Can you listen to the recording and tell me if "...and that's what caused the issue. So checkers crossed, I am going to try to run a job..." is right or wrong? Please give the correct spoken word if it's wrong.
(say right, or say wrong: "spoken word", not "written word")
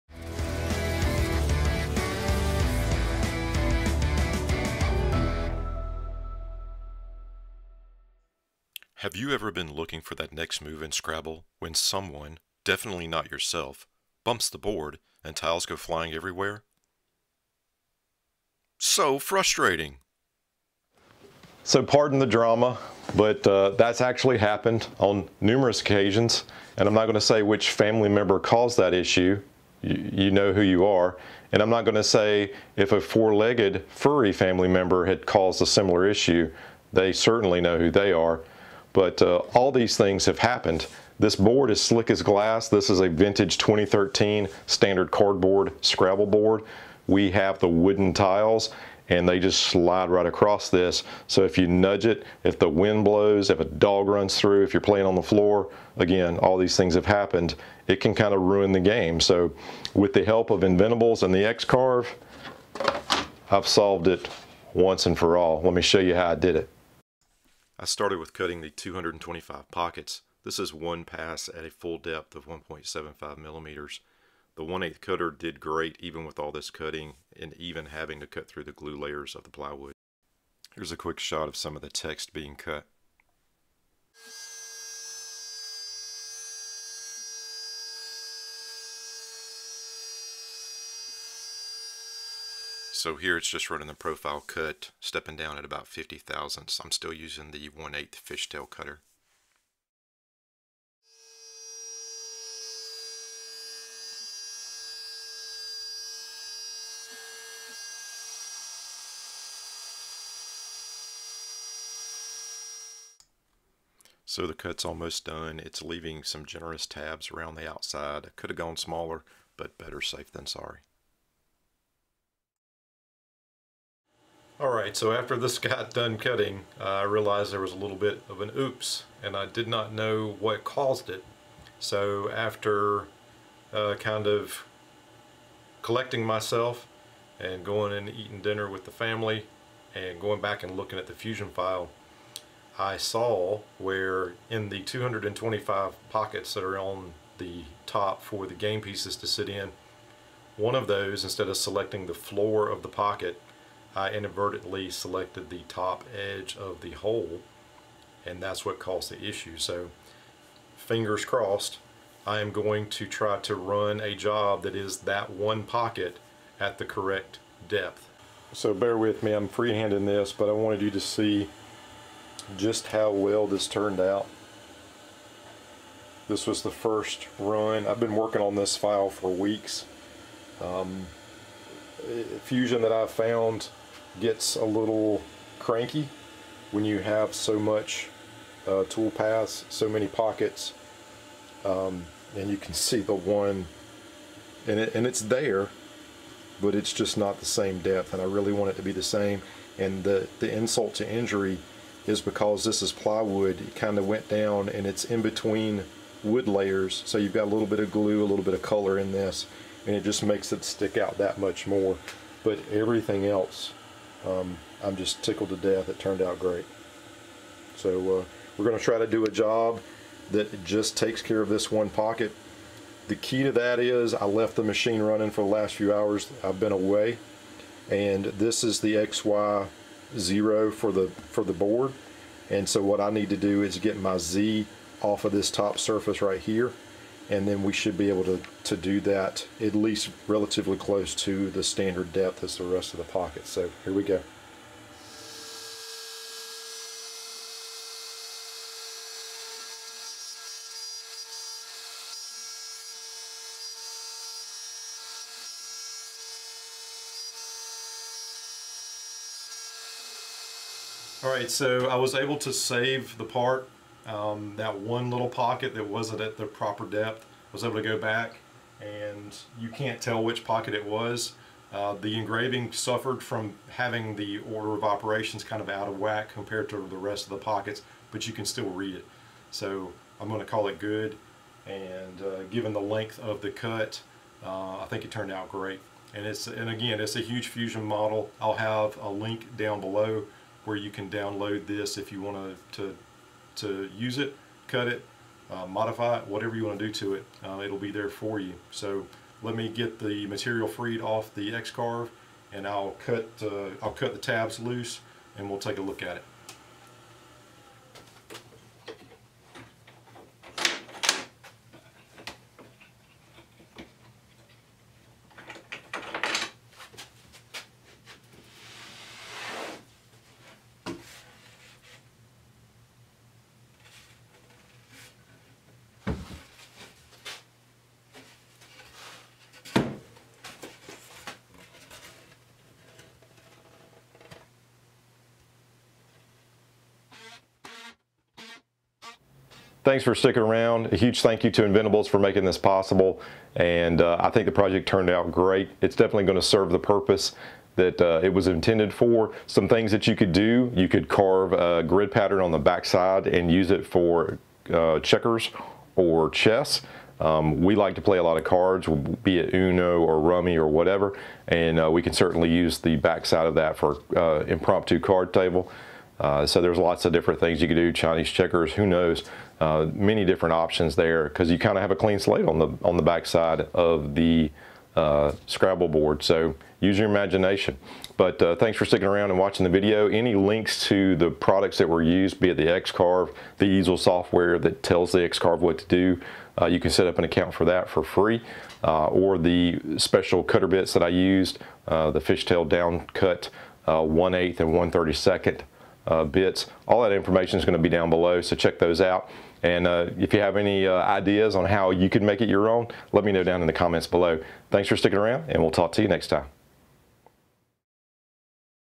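wrong: "fingers", not "checkers".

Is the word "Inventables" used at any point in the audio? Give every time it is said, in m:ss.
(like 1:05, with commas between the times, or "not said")
1:00, 5:41.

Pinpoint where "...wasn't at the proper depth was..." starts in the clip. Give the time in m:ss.
4:25.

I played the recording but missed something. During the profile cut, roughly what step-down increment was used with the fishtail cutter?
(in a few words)
50 thousandths.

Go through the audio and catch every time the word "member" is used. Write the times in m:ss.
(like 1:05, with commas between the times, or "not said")
0:28, 0:34.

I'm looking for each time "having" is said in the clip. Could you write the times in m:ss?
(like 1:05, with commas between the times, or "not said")
1:17, 4:33.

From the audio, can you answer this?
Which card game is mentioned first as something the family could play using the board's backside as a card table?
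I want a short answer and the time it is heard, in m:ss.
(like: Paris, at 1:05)
Uno, at 5:59.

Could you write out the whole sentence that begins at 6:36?
All that information is going to be down below, so check those out.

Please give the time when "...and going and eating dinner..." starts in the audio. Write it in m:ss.
2:17.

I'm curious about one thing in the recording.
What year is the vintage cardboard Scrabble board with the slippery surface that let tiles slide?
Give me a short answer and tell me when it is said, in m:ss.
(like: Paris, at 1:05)
2013, at 0:43.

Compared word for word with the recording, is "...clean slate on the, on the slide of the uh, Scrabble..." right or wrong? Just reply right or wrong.
wrong.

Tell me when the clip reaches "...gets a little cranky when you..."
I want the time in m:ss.
3:04.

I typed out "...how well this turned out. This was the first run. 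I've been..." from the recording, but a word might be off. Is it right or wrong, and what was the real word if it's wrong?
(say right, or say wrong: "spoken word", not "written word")
right.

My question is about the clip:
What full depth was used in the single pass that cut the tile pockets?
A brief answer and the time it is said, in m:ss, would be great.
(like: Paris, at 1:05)
1.75 millimeters, at 1:12.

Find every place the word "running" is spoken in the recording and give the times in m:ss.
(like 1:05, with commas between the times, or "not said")
1:33, 3:45.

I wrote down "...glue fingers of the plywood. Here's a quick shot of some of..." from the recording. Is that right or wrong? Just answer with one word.
wrong.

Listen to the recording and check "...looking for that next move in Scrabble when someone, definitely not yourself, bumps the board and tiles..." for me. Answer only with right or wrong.
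right.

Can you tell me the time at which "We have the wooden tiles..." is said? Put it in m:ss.
0:47.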